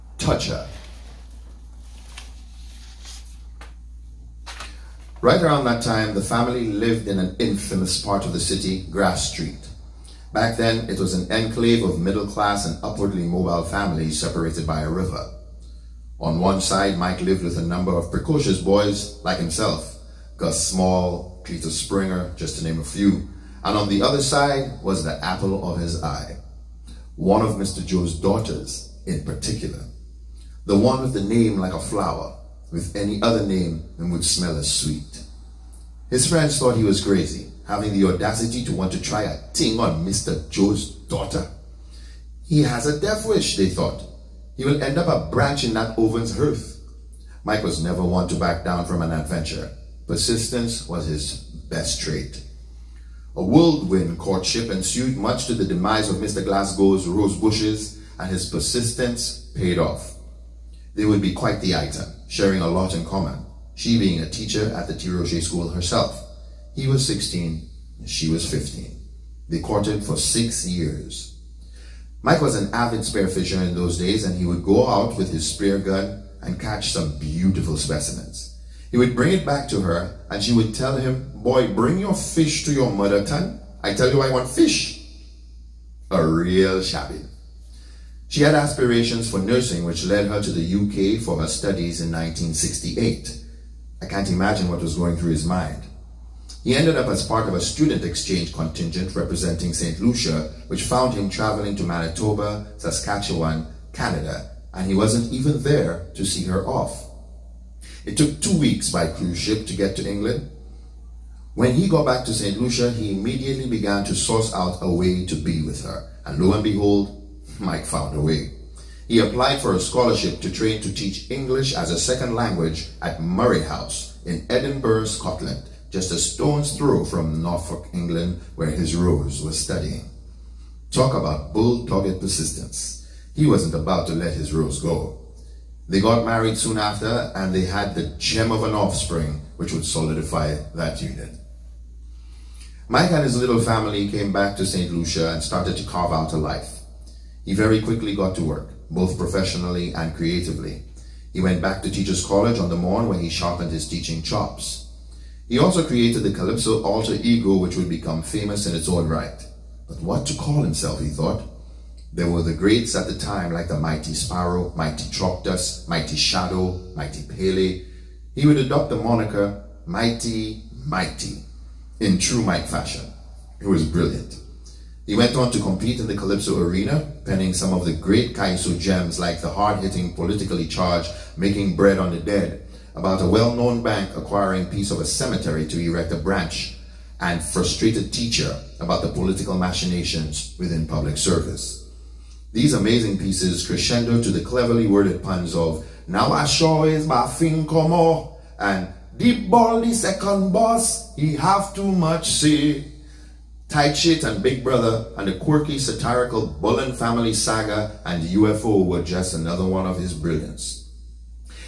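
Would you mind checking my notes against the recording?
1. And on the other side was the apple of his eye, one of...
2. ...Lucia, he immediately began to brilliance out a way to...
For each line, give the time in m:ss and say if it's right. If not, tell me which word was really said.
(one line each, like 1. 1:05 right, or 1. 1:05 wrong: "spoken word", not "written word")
1. 0:23 right
2. 1:52 wrong: "source", not "brilliance".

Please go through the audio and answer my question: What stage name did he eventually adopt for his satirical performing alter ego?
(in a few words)
Mighty Mighty.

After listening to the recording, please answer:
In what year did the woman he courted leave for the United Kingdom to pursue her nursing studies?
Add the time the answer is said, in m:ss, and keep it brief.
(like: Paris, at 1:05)
1968, at 1:32.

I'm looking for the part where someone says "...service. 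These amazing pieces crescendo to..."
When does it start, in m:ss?
3:11.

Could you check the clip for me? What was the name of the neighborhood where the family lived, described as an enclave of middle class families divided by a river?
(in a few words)
Grass Street.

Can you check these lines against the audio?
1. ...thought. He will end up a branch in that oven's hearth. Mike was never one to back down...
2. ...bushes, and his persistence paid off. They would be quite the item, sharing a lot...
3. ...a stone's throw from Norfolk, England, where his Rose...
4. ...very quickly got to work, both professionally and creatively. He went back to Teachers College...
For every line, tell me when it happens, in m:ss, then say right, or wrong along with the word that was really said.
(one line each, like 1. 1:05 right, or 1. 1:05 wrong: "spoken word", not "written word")
1. 0:43 right
2. 0:57 right
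3. 2:06 right
4. 2:27 right.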